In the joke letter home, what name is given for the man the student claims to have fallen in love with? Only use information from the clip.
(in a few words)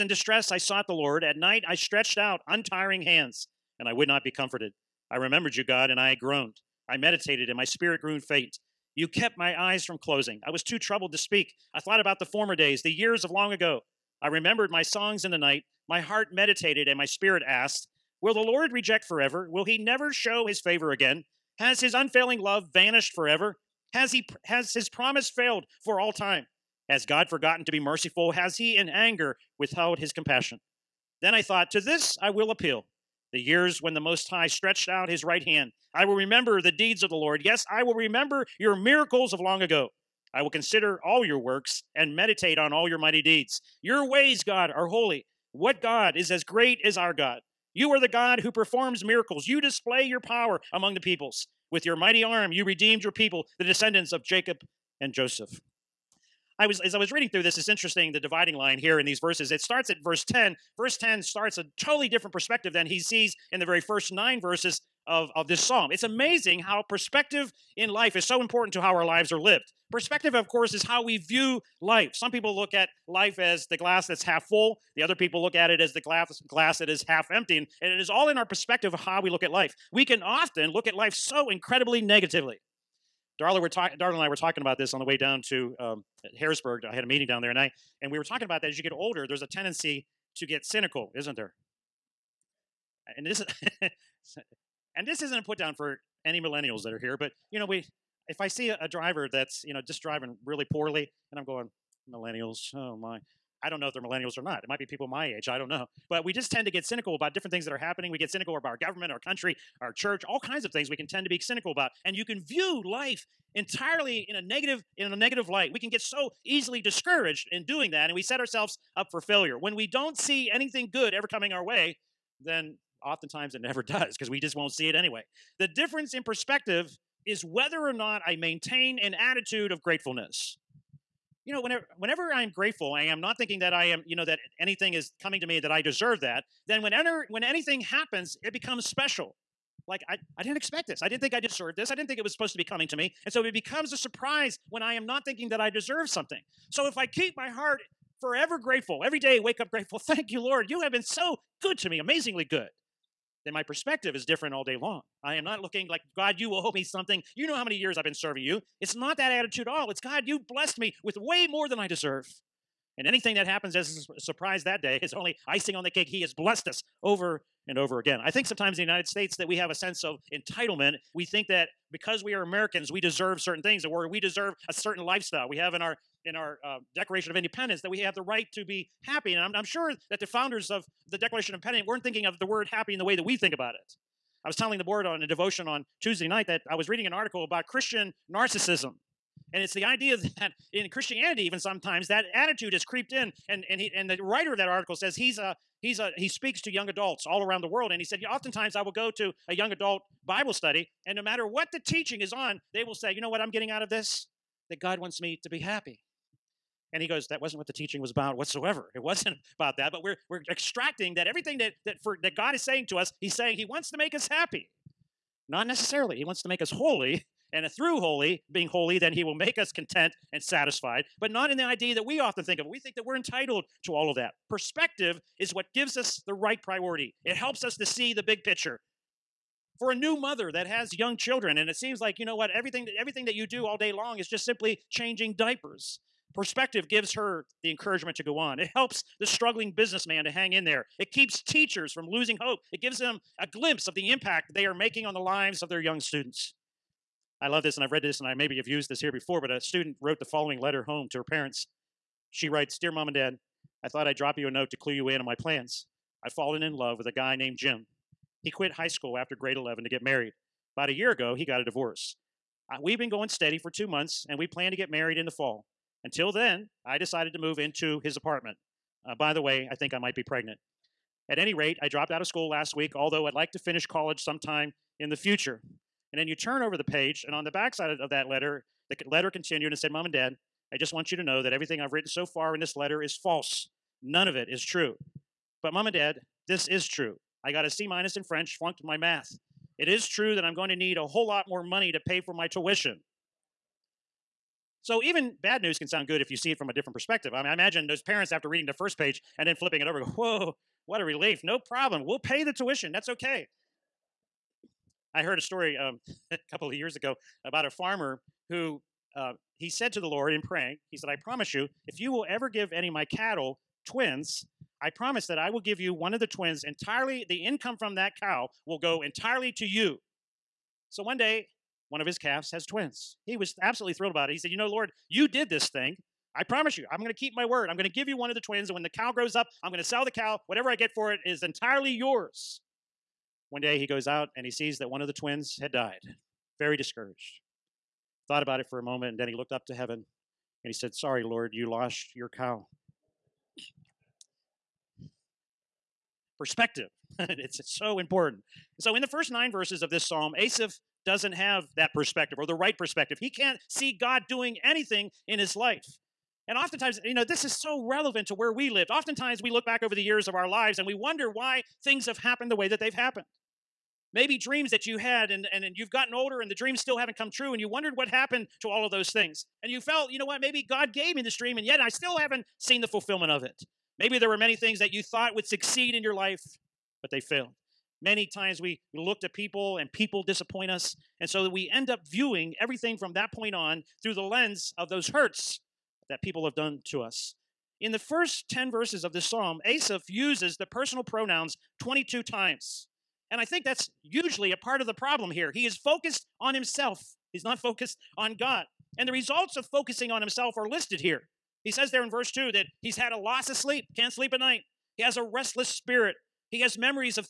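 Jim.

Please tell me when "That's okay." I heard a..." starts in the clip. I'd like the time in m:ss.
5:02.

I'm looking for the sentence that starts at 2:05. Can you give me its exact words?
The difference in perspective is whether or not I maintain an attitude of gratefulness.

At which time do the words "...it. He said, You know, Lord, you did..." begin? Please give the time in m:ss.
5:24.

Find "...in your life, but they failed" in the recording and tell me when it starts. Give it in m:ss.
6:15.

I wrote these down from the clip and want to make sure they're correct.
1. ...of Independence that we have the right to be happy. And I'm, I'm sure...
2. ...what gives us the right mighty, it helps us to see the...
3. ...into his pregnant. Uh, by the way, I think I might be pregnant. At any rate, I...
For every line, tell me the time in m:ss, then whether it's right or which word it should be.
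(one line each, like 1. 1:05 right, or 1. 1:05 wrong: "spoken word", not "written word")
1. 2:57 right
2. 3:45 wrong: "priority", not "mighty"
3. 4:27 wrong: "apartment", not "pregnant".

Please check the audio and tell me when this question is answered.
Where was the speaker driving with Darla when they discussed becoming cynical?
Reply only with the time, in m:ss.
1:26.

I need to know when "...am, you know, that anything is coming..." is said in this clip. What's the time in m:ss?
2:13.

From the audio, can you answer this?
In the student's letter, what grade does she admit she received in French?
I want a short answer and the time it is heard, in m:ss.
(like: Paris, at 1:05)
C minus, at 4:47.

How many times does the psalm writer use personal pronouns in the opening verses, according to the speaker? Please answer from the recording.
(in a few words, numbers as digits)
22.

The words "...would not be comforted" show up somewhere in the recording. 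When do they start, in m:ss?
0:03.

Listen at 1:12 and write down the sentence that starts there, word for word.
Some people look at life as the glass that's half full.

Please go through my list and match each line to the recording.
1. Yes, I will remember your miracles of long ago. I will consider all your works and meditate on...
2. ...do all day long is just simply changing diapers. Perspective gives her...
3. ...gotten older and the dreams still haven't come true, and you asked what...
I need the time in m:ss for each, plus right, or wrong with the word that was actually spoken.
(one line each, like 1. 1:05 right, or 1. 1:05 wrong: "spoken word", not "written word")
1. 0:37 right
2. 3:53 right
3. 6:05 wrong: "wondered", not "asked".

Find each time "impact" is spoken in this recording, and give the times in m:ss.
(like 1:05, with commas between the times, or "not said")
4:04.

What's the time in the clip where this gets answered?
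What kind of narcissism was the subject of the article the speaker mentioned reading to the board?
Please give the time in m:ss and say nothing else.
3:07.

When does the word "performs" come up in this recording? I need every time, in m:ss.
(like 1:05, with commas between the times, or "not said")
0:48.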